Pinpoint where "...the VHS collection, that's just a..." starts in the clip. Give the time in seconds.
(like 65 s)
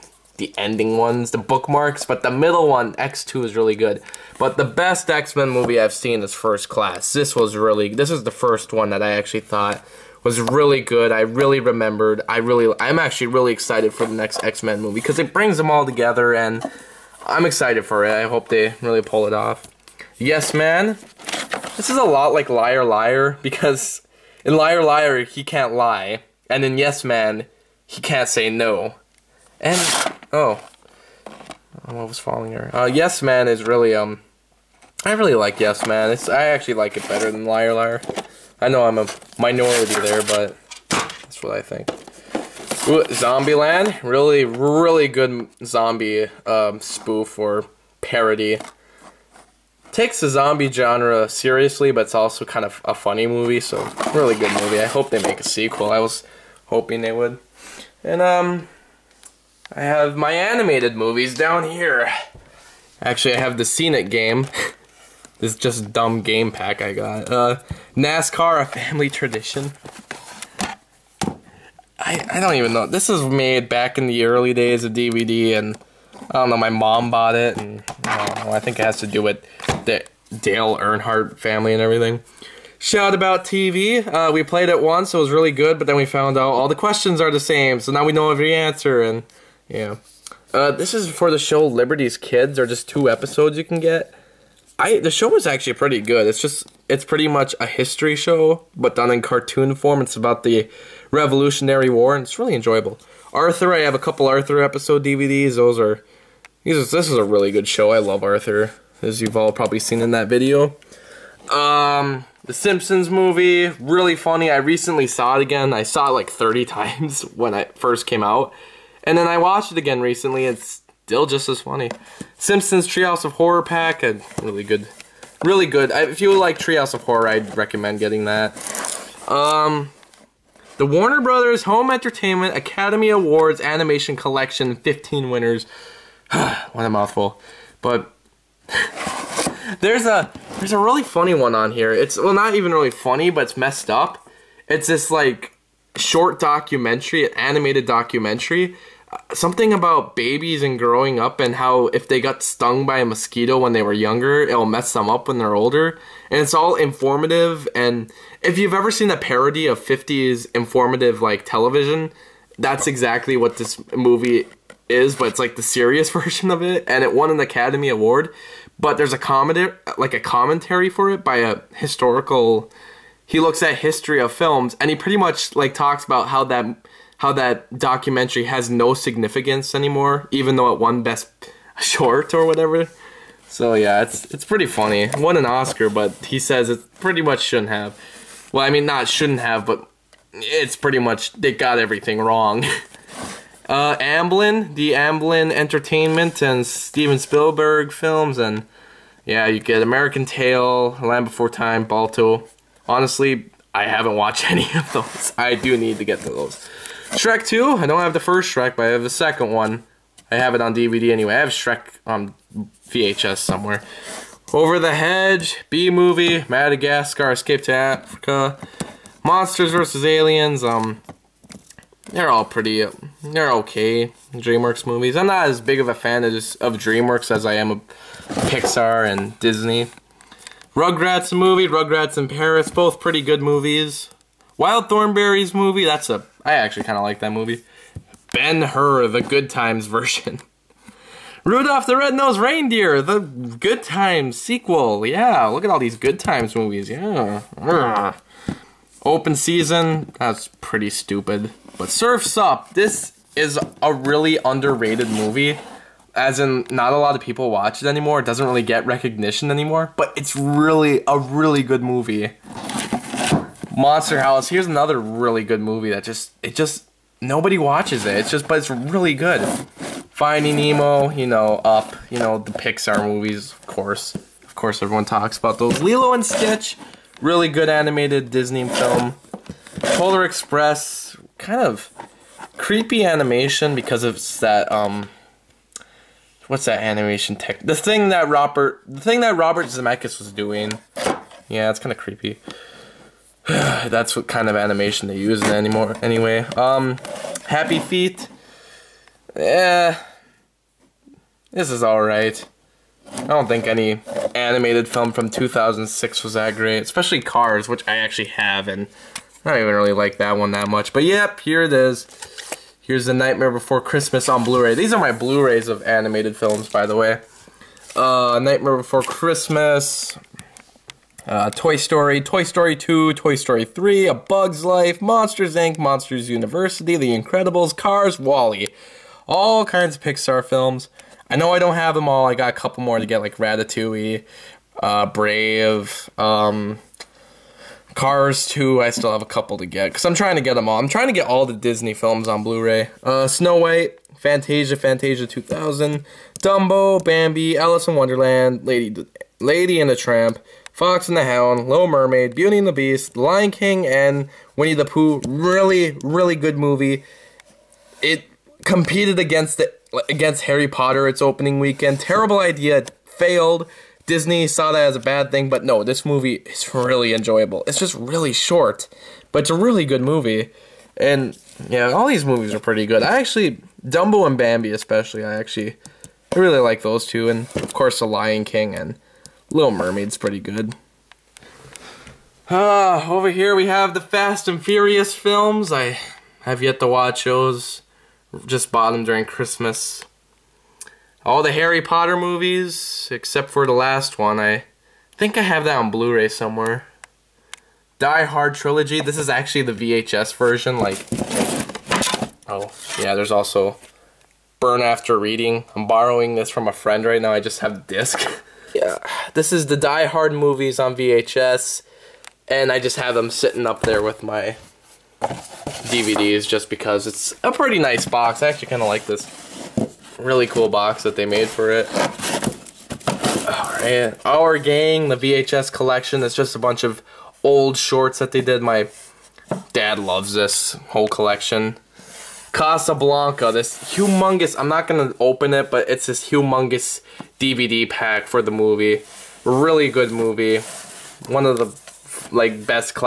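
425 s.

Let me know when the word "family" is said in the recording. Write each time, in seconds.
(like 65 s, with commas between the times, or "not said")
68 s, 81 s.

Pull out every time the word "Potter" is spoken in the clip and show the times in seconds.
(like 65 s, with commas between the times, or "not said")
360 s, 391 s.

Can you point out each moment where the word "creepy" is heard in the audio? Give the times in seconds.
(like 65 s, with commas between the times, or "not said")
282 s, 291 s.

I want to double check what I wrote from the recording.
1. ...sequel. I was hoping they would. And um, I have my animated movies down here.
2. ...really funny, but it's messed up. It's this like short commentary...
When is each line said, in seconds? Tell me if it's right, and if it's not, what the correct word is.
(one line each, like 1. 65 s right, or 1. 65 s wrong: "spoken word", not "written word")
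1. 55 s right
2. 142 s wrong: "documentary", not "commentary".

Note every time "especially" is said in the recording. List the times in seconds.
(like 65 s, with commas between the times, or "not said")
306 s, 374 s.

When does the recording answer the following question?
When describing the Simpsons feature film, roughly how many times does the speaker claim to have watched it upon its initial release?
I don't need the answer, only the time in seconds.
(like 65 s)
116 s.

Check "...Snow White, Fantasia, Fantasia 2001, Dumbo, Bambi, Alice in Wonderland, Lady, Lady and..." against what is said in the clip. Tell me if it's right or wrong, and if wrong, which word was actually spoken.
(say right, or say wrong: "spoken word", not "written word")
wrong: "2000", not "2001".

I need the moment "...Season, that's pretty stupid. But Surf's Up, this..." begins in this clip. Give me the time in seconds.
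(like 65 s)
249 s.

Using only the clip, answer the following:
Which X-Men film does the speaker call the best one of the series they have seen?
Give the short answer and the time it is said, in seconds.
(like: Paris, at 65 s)
First Class, at 6 s.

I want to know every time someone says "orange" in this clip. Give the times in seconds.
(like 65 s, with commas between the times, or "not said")
not said.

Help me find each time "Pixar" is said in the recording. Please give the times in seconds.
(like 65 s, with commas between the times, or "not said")
228 s, 272 s, 330 s.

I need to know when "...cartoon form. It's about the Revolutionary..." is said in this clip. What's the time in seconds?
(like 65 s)
99 s.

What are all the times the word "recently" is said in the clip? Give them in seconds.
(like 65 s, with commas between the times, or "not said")
114 s, 120 s.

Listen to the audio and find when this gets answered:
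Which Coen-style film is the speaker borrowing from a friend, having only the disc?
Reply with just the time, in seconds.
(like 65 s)
404 s.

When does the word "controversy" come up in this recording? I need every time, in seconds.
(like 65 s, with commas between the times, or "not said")
not said.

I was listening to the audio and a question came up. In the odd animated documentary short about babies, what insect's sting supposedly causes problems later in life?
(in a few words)
mosquito.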